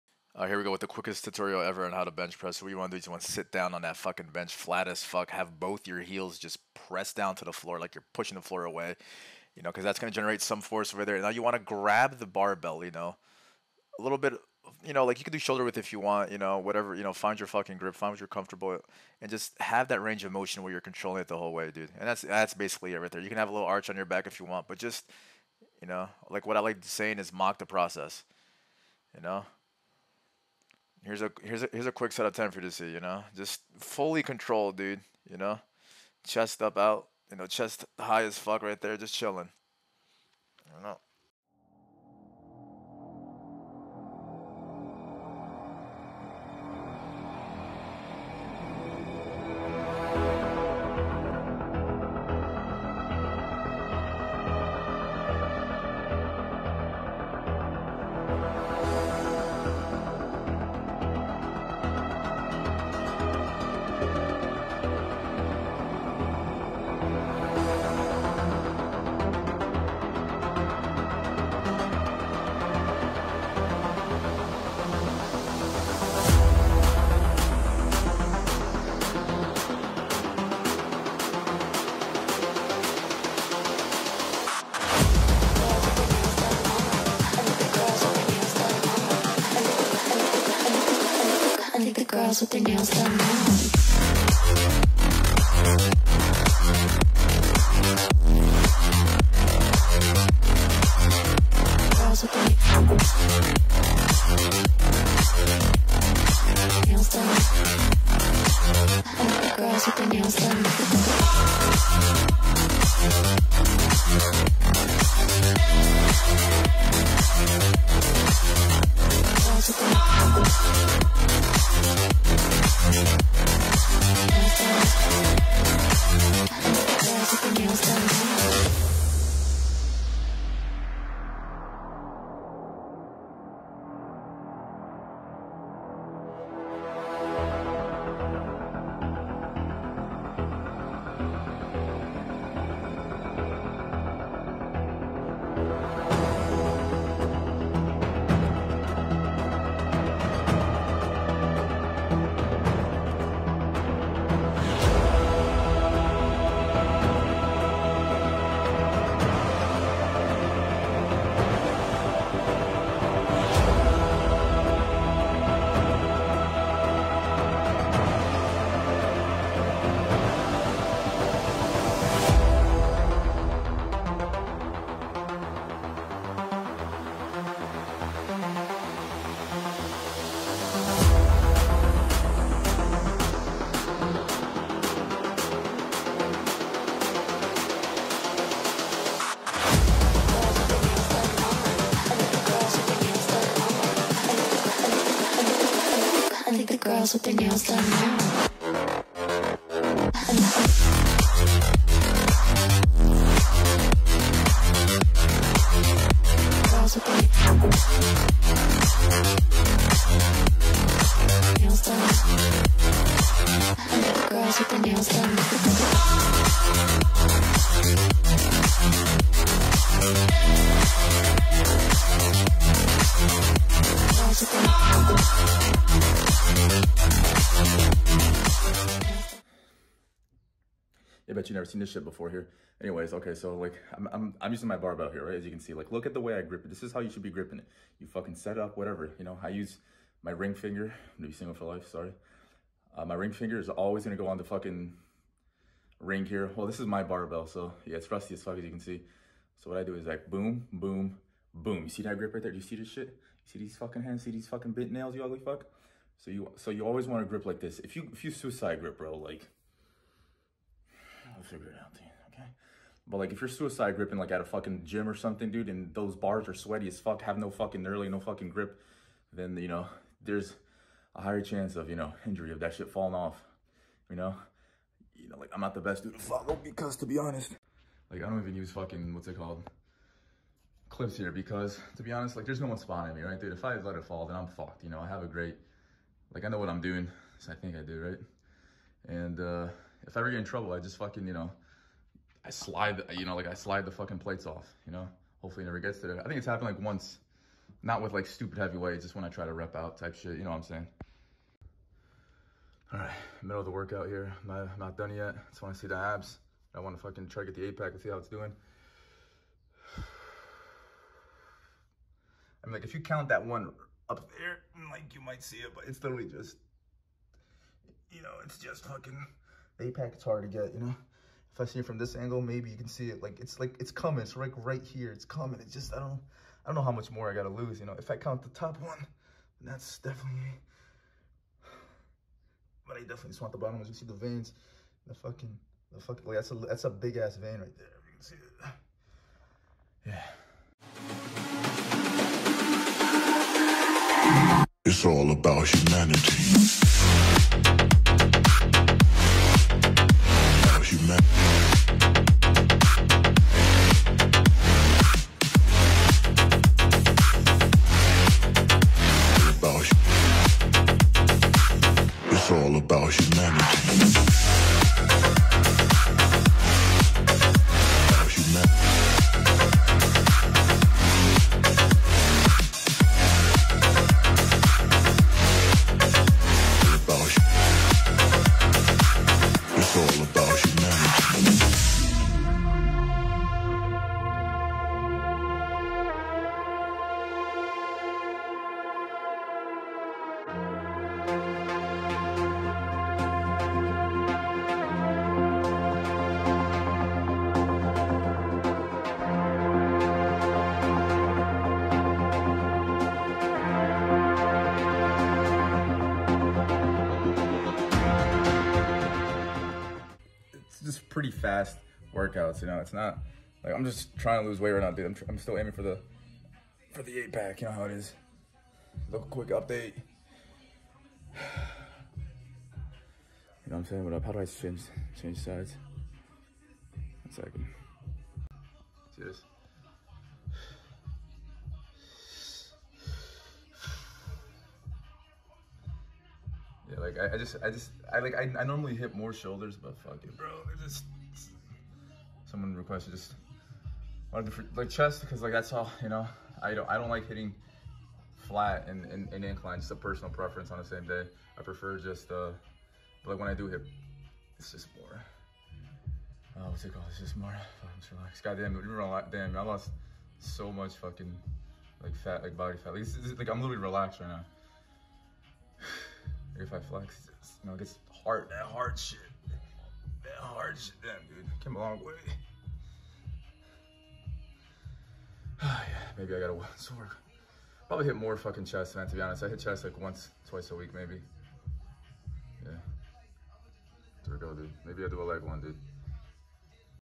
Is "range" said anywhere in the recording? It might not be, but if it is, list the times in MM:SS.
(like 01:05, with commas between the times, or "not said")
00:20.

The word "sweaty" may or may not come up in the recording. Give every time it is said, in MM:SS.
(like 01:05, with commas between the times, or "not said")
04:26.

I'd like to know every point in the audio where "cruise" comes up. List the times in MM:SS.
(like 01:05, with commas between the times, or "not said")
not said.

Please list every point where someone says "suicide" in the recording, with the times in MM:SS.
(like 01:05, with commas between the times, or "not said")
04:18, 04:23.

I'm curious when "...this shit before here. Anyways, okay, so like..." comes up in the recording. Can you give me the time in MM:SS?
03:51.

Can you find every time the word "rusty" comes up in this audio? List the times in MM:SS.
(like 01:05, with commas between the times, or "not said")
04:08.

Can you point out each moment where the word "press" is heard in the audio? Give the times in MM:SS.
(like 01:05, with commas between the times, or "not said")
00:02, 00:06.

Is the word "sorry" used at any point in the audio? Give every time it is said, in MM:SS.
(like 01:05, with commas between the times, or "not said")
04:01.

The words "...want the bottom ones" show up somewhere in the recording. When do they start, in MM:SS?
05:33.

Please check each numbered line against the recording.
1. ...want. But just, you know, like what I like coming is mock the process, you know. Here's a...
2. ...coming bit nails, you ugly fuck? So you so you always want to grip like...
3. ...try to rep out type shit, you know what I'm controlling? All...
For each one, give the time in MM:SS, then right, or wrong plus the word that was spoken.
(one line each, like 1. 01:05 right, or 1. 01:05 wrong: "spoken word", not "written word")
1. 00:24 wrong: "saying", not "coming"
2. 04:14 wrong: "fucking", not "coming"
3. 04:59 wrong: "saying", not "controlling".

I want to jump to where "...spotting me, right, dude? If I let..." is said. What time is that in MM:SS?
04:42.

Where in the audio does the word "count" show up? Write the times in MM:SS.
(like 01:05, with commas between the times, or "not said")
05:12, 05:28.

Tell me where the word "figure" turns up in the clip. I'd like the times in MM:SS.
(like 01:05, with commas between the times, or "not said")
04:21.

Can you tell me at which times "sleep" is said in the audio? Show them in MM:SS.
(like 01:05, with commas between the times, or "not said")
not said.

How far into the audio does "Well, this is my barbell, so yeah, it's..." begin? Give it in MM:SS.
04:06.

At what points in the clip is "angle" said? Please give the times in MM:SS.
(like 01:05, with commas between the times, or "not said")
05:22.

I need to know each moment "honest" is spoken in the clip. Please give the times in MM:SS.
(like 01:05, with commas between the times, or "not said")
04:37, 04:42, 07:59.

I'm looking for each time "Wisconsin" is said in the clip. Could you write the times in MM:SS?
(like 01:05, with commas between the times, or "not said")
not said.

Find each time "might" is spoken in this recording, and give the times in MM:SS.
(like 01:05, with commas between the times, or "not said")
05:15.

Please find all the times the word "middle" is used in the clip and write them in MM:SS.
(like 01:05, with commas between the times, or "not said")
05:03.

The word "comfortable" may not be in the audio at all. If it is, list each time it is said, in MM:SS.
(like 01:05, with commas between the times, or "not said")
00:18.